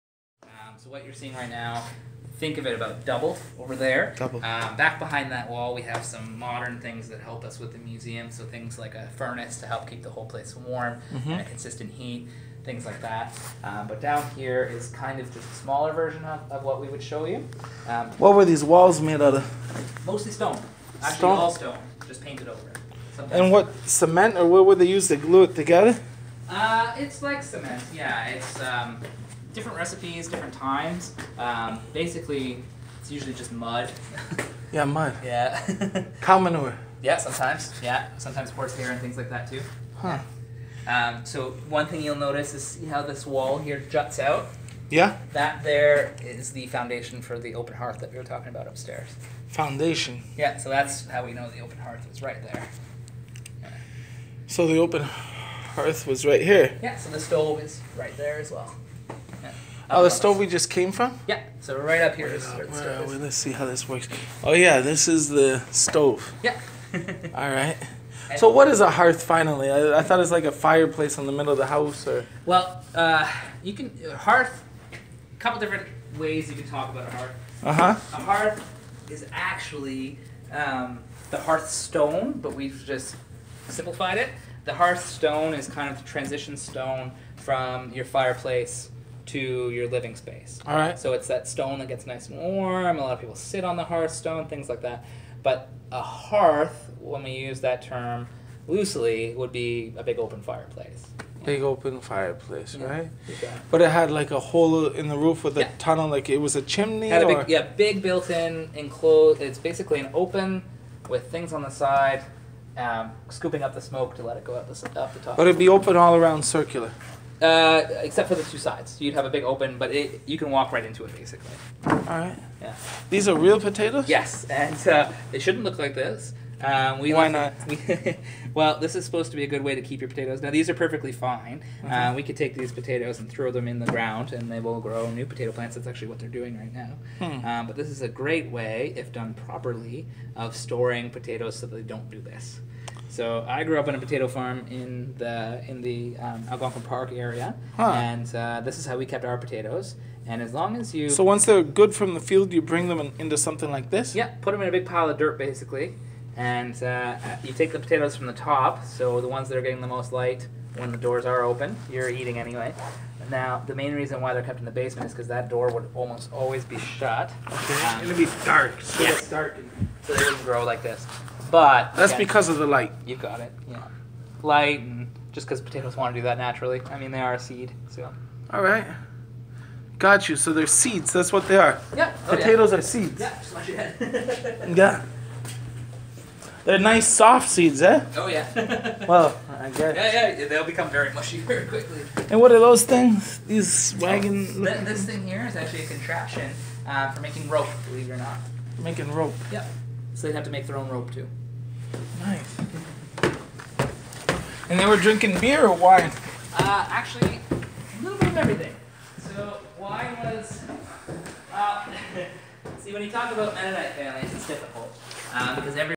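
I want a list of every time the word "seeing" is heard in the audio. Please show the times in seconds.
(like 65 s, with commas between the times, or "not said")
1 s.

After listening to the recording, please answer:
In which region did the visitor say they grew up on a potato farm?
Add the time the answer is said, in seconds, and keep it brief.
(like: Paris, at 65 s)
Algonquin Park, at 146 s.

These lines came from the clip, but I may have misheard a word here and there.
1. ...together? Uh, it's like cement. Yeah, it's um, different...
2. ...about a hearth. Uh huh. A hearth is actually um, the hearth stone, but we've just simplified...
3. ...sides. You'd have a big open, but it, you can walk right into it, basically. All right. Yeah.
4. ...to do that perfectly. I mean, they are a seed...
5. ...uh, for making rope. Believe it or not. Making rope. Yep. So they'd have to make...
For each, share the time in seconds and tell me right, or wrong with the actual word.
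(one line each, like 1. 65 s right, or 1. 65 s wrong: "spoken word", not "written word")
1. 25 s right
2. 76 s right
3. 118 s right
4. 176 s wrong: "naturally", not "perfectly"
5. 196 s right.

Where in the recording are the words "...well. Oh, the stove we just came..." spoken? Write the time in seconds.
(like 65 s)
58 s.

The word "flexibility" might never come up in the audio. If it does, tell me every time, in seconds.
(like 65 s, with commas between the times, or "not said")
not said.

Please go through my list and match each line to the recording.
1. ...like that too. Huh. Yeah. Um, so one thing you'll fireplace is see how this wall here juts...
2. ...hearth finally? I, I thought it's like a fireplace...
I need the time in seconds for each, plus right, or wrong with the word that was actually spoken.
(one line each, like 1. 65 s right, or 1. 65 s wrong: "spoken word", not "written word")
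1. 39 s wrong: "notice", not "fireplace"
2. 68 s right.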